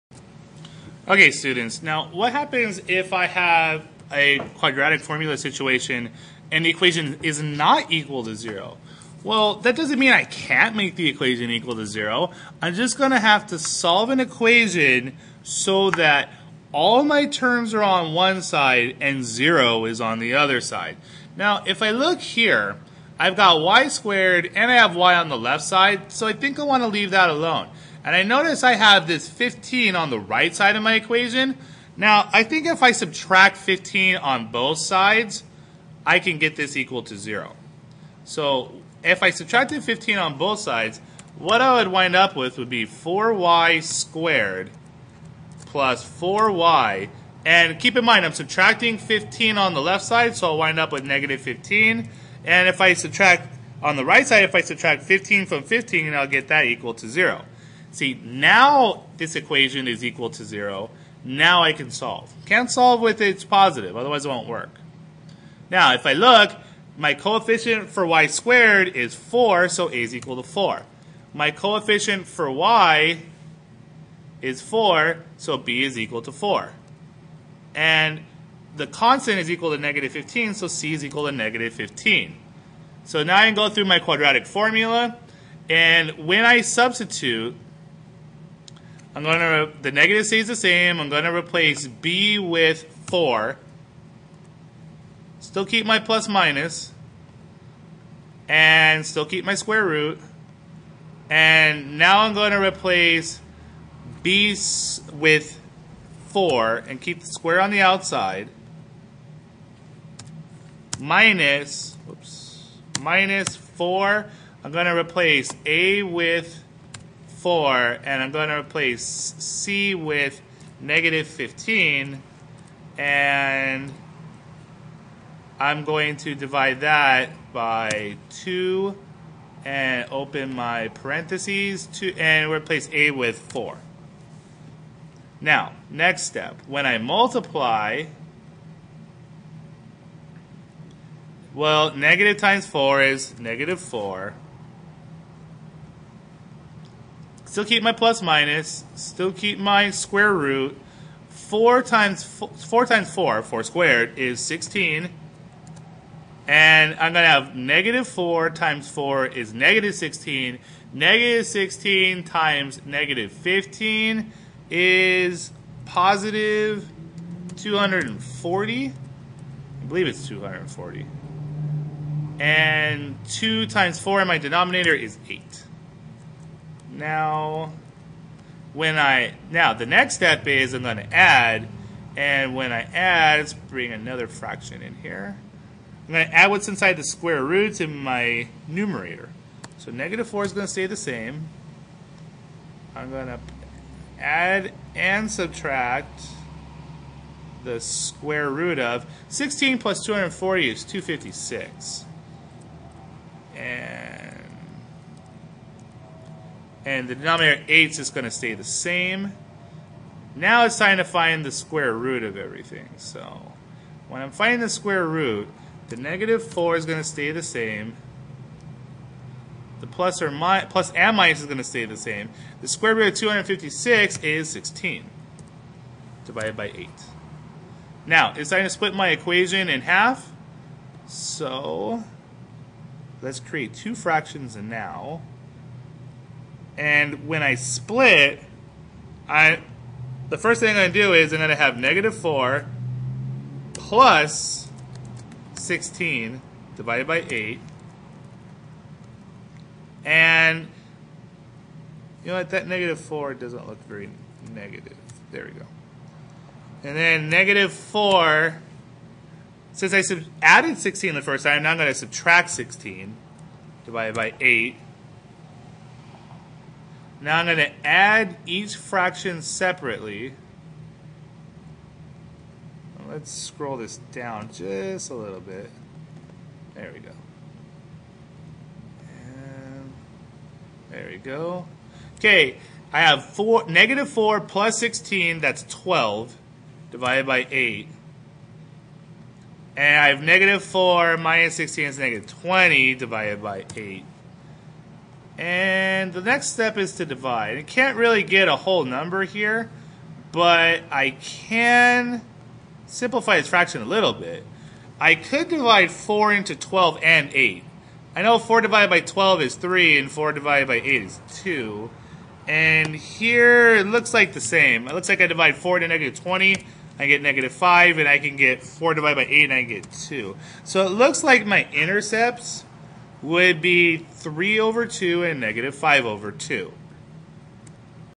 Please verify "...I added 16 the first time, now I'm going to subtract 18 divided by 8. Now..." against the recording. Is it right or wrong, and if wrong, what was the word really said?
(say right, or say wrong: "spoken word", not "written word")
wrong: "16", not "18".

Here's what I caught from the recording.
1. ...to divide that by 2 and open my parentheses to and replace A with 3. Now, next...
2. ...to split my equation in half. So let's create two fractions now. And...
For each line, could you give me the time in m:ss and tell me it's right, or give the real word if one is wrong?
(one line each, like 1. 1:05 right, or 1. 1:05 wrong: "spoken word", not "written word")
1. 2:06 wrong: "4", not "3"
2. 3:48 right.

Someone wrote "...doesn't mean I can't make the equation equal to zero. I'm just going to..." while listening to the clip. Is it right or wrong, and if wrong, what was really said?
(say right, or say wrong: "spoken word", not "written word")
right.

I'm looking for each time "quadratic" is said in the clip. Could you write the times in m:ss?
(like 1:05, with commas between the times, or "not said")
0:04, 1:23.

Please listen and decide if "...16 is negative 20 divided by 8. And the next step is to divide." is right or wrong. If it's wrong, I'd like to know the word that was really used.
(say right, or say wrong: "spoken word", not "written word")
right.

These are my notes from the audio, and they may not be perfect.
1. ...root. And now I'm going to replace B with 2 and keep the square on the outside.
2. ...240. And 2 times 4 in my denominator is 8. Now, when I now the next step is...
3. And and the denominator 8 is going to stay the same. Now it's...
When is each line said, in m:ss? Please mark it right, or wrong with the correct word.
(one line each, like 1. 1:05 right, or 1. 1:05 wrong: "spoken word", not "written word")
1. 1:39 wrong: "4", not "2"
2. 2:50 right
3. 3:23 right.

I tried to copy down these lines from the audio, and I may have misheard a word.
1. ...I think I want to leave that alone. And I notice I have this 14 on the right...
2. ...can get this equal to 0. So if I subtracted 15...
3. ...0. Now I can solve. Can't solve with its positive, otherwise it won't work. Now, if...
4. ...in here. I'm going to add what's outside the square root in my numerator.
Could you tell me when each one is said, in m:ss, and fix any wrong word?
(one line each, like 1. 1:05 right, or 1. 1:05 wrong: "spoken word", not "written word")
1. 0:26 wrong: "15", not "14"
2. 0:36 right
3. 1:00 right
4. 3:04 wrong: "inside", not "outside".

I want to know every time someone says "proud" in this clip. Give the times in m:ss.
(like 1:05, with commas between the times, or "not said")
not said.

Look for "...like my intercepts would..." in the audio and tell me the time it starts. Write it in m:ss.
5:21.